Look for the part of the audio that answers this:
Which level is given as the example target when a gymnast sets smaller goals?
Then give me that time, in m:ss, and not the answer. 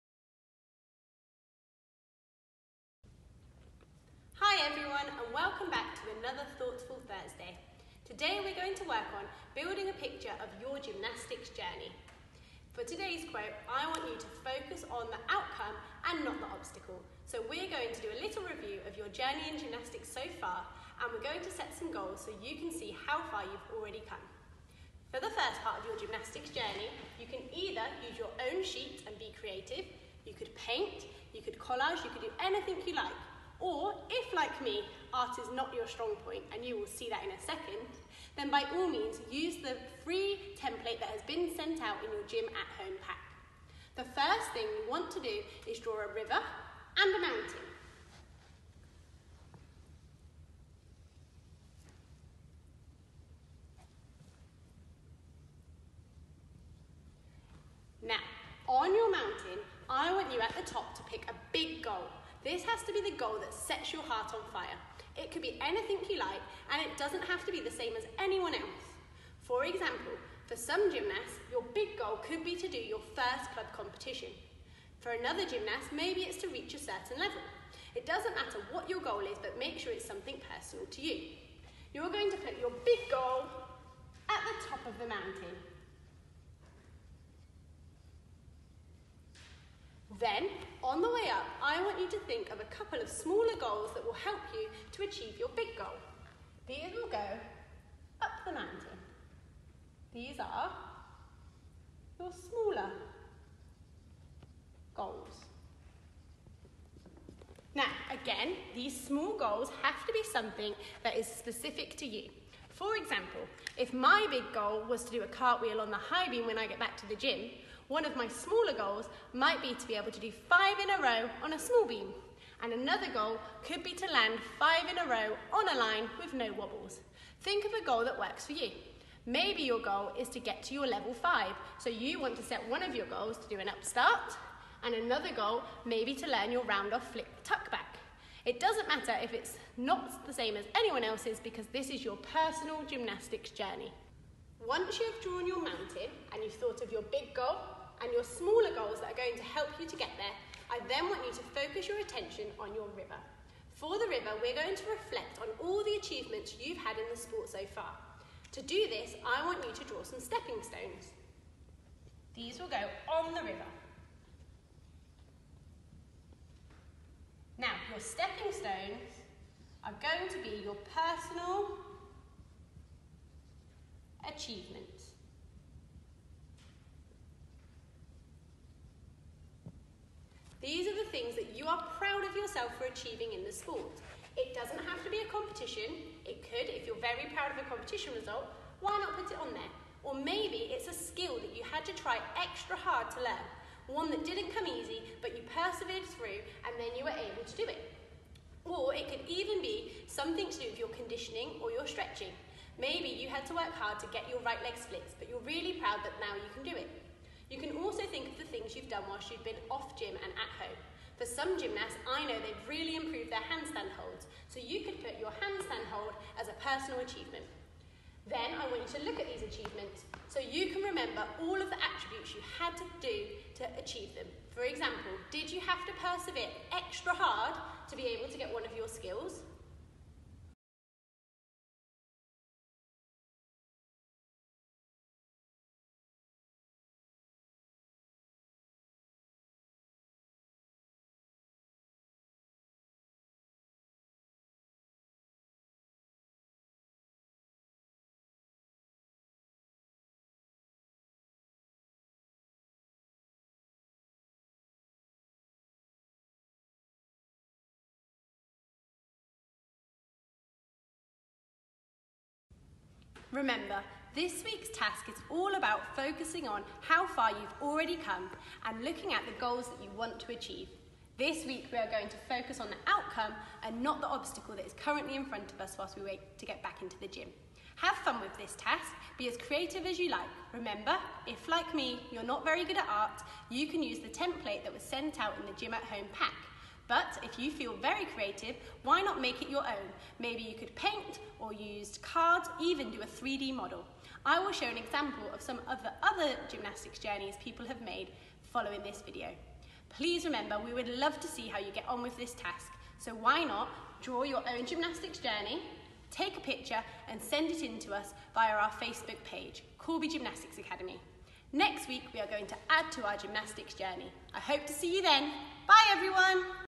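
2:10.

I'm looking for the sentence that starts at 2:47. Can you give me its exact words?
Now, your stepping stones are going to be your personal achievements.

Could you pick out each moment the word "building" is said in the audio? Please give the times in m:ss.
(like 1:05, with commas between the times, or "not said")
0:09.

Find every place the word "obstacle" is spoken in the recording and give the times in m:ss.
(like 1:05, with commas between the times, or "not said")
0:16, 4:34.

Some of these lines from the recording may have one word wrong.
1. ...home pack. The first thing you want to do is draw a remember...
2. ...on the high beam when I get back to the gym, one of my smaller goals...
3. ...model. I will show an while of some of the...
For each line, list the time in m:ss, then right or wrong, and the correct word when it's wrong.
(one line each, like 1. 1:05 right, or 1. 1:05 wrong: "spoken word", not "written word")
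1. 0:42 wrong: "river", not "remember"
2. 1:55 right
3. 4:53 wrong: "example", not "while".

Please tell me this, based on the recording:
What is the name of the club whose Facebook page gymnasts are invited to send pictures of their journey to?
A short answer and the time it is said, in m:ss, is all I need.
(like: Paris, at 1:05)
Corby Gymnastics Academy, at 5:09.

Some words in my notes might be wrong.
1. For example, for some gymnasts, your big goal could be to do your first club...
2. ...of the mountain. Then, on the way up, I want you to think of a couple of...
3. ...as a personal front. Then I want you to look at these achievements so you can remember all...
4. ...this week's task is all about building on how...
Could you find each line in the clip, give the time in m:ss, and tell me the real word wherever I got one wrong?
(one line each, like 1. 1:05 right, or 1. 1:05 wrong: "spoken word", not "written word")
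1. 1:09 right
2. 1:24 right
3. 3:36 wrong: "achievement", not "front"
4. 4:24 wrong: "focusing", not "building".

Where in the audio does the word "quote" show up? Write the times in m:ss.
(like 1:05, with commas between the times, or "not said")
0:13.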